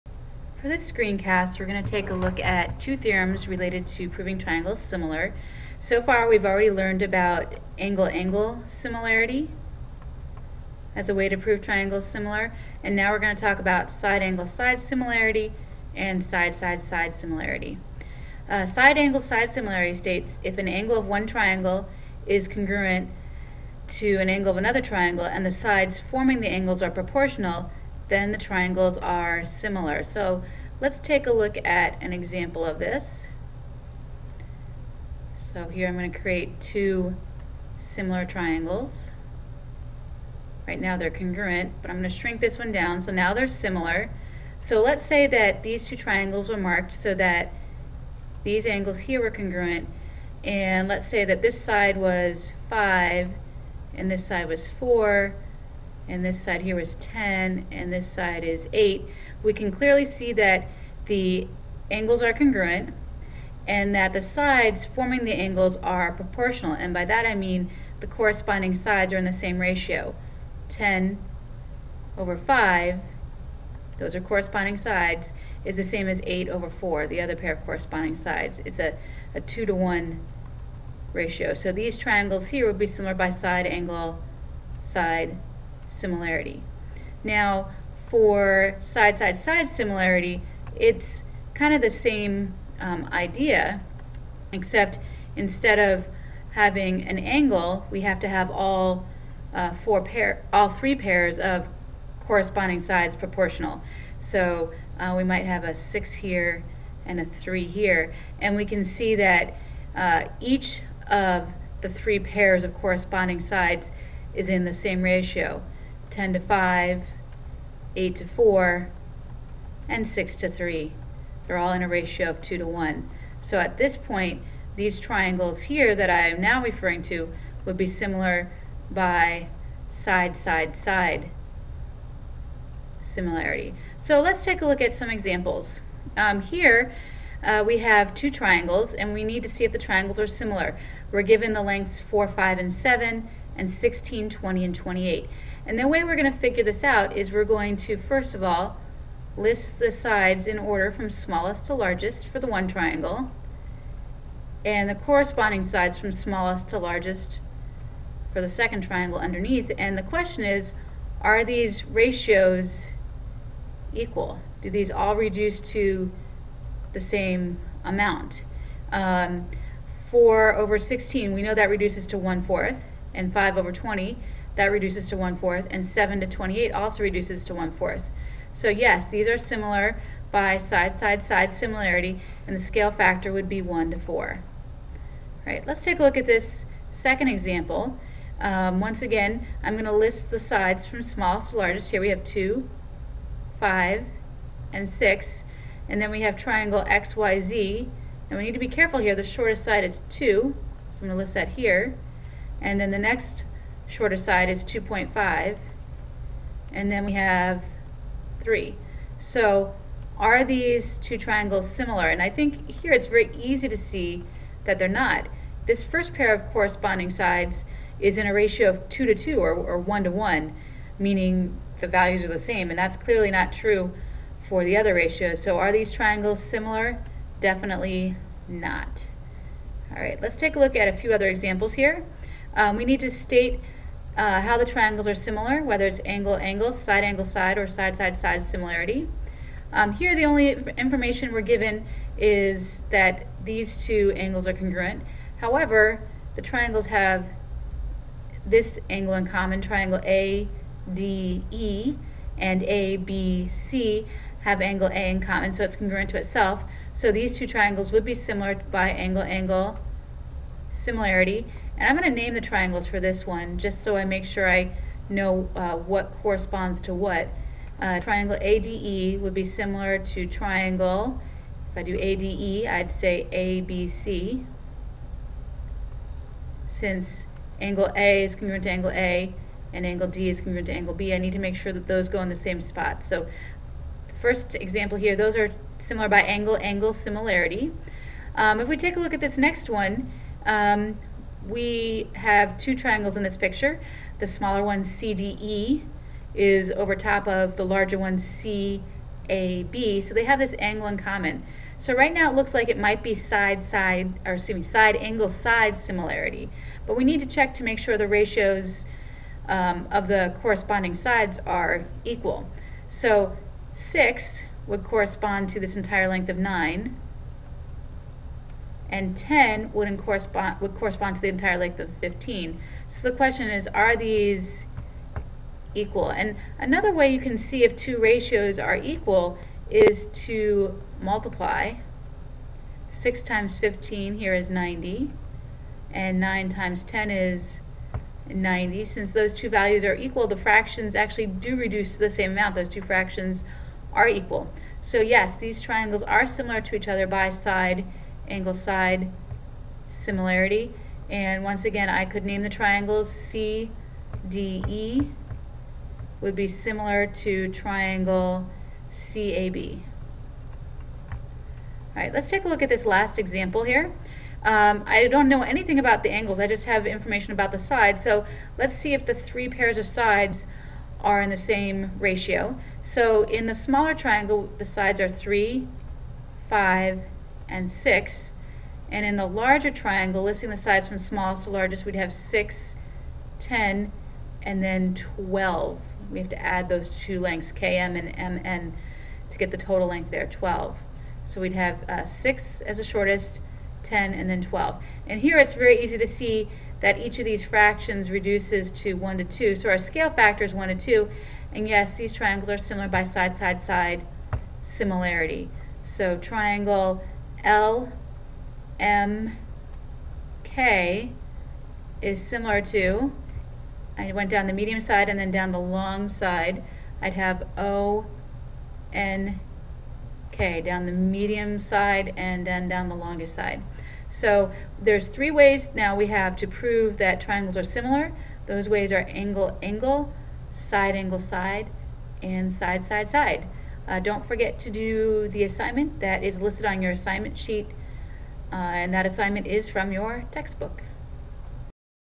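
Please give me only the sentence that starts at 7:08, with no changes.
Those ways are angle, angle, side, angle, side, and side, side, side.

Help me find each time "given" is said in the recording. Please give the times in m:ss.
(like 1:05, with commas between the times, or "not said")
2:21, 4:01.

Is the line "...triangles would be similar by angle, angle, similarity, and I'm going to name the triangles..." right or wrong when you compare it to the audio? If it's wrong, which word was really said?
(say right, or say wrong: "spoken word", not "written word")
right.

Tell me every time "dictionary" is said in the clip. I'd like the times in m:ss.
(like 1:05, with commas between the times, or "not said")
not said.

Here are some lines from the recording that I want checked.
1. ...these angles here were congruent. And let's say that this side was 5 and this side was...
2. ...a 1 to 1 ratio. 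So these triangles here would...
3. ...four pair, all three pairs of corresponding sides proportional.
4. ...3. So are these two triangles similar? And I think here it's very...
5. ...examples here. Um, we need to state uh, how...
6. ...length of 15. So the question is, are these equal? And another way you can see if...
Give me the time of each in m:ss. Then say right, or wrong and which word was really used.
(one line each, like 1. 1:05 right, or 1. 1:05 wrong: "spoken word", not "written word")
1. 0:48 right
2. 1:19 wrong: "2", not "1"
3. 1:39 right
4. 3:28 right
5. 3:51 right
6. 5:21 right.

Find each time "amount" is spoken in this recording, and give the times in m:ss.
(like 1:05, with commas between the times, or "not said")
2:47, 5:42.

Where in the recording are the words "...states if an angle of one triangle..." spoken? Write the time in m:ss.
0:19.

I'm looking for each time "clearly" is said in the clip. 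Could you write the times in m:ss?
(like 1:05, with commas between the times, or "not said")
0:59, 3:42.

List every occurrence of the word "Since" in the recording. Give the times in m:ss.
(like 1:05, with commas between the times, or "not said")
4:36, 5:38.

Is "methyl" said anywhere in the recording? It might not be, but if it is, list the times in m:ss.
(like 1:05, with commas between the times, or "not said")
not said.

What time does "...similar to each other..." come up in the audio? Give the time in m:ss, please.
5:46.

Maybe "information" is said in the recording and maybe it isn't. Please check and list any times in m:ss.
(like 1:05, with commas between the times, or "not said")
4:00, 6:06.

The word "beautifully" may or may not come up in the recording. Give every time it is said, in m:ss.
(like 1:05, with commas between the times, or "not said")
not said.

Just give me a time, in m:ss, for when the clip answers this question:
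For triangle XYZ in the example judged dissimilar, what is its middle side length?
3:24.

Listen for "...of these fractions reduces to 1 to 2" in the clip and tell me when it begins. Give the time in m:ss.
6:37.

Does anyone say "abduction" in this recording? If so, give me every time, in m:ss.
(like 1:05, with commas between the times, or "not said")
not said.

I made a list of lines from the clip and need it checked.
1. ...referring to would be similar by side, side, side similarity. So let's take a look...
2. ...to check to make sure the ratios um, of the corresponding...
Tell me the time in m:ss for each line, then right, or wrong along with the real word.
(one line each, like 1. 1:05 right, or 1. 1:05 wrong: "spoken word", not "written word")
1. 2:06 right
2. 5:07 right.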